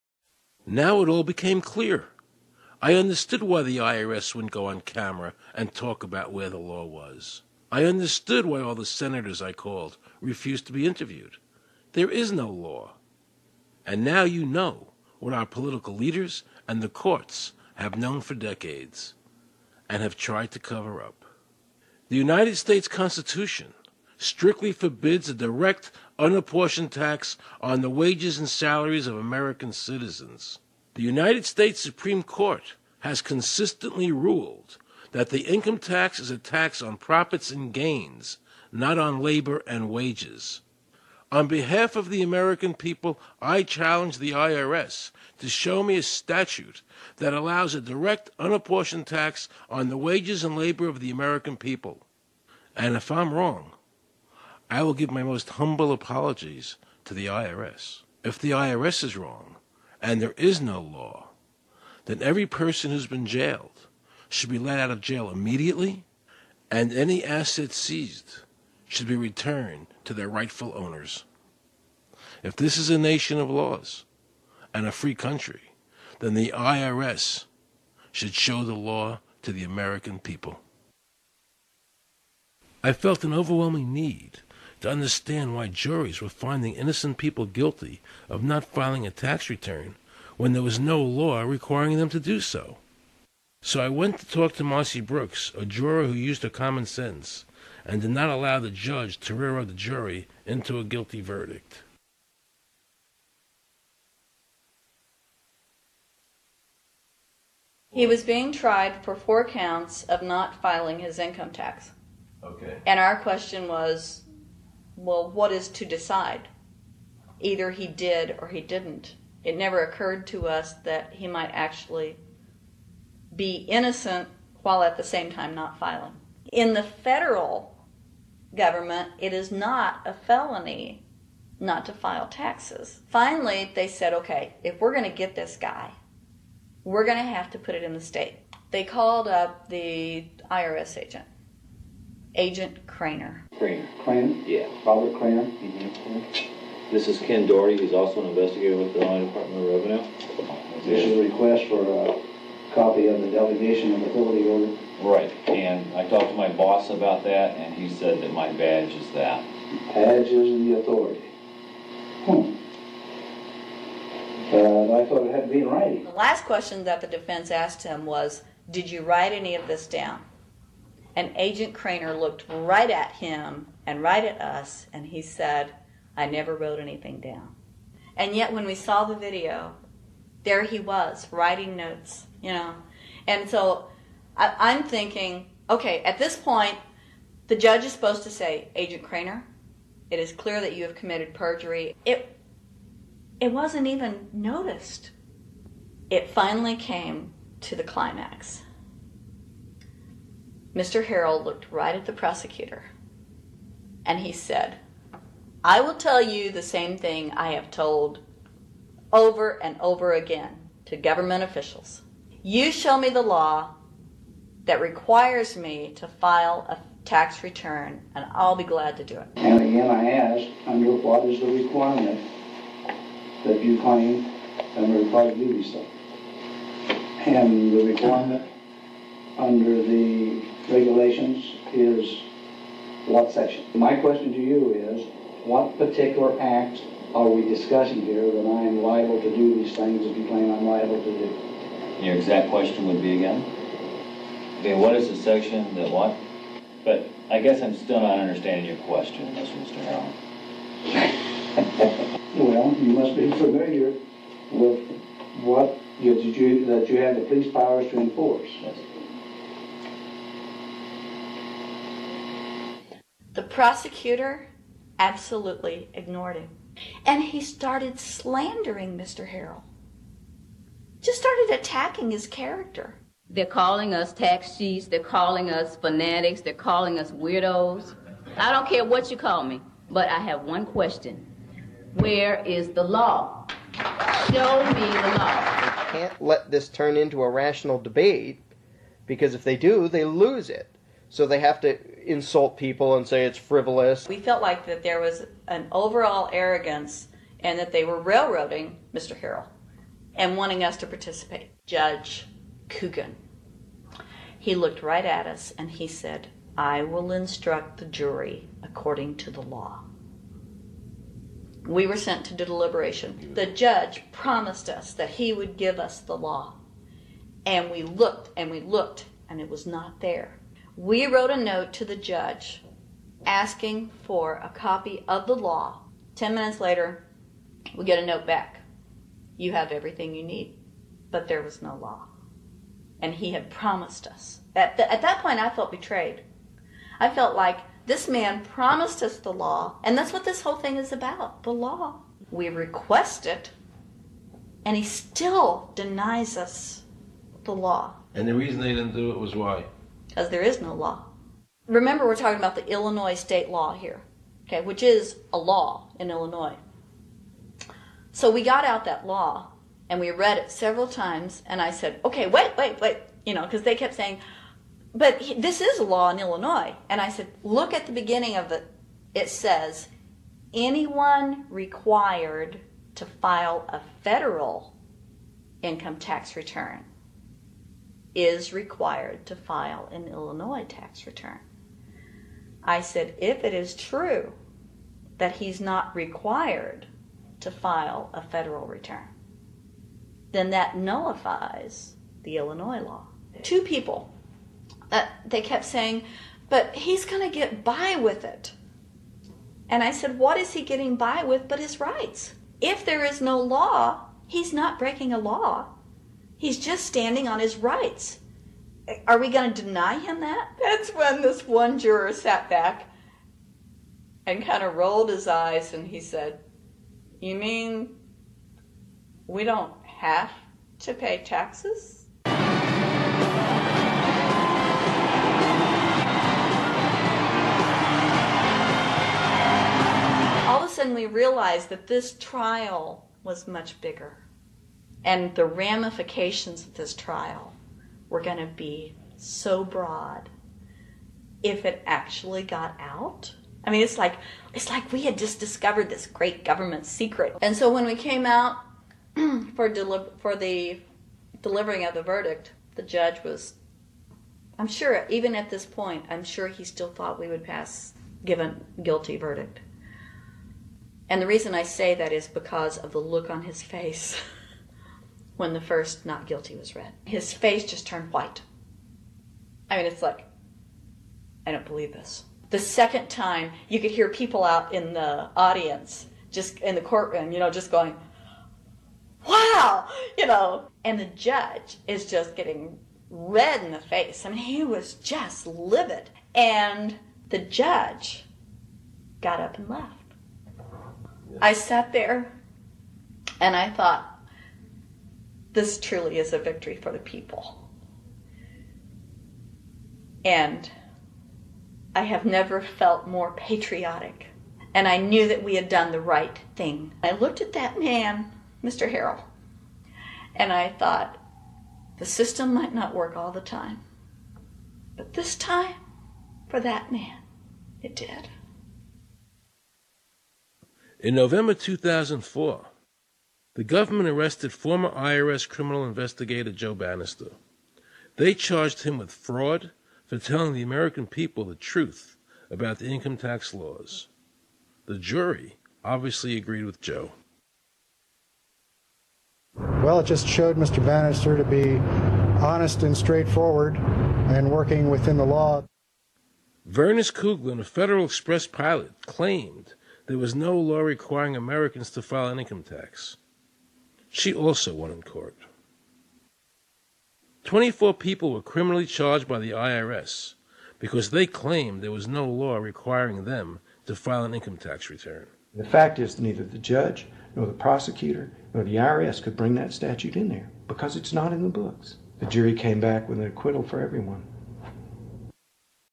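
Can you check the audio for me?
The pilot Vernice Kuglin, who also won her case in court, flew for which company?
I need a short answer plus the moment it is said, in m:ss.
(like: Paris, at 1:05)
Federal Express, at 9:07.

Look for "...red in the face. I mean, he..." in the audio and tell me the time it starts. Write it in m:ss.
8:03.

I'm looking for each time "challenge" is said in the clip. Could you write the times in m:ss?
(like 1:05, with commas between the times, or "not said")
0:43.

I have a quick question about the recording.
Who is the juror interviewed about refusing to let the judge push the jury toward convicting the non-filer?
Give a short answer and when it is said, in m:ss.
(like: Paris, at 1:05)
Marcy Brooks, at 1:34.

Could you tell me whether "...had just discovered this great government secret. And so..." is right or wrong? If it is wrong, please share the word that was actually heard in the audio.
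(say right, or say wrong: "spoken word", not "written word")
right.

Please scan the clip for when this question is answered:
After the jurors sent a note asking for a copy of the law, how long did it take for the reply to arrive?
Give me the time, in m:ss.
5:26.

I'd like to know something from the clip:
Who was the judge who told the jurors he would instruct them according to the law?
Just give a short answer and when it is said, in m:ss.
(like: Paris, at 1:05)
Judge Coogan, at 5:01.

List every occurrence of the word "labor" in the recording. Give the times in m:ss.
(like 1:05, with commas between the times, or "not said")
0:39, 0:50.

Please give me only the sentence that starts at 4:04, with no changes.
Okay, what is the section that what?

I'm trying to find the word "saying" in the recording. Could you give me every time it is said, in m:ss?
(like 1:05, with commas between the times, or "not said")
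6:03, 6:35.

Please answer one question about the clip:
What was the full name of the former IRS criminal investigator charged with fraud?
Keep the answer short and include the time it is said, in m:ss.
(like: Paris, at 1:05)
Joe Bannister, at 8:46.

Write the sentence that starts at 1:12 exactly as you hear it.
If this is a nation of laws and a free country, then the IRS should show the law to the American people.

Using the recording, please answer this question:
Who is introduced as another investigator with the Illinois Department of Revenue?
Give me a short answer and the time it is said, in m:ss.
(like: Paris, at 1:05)
Ken Doherty, at 2:27.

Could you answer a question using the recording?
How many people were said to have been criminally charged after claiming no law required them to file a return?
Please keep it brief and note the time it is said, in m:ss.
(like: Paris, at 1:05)
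24, at 9:17.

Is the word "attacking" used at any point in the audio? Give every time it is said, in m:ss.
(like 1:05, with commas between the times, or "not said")
4:31.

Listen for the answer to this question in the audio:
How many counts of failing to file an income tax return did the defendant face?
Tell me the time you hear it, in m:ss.
1:49.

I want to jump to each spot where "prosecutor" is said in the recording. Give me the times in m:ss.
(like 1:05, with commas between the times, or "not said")
3:22, 4:23, 9:27.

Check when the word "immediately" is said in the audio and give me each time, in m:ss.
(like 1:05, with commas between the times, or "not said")
1:05.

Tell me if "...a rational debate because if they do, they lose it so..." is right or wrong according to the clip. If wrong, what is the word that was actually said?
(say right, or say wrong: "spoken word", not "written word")
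right.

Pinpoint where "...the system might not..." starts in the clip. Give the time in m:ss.
8:31.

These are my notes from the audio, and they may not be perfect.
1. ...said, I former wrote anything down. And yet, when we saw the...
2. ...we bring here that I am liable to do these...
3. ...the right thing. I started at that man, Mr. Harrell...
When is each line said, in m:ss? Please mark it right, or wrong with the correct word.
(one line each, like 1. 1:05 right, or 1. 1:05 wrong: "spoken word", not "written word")
1. 2:55 wrong: "never", not "former"
2. 3:57 wrong: "discussing", not "bring"
3. 8:25 wrong: "looked", not "started".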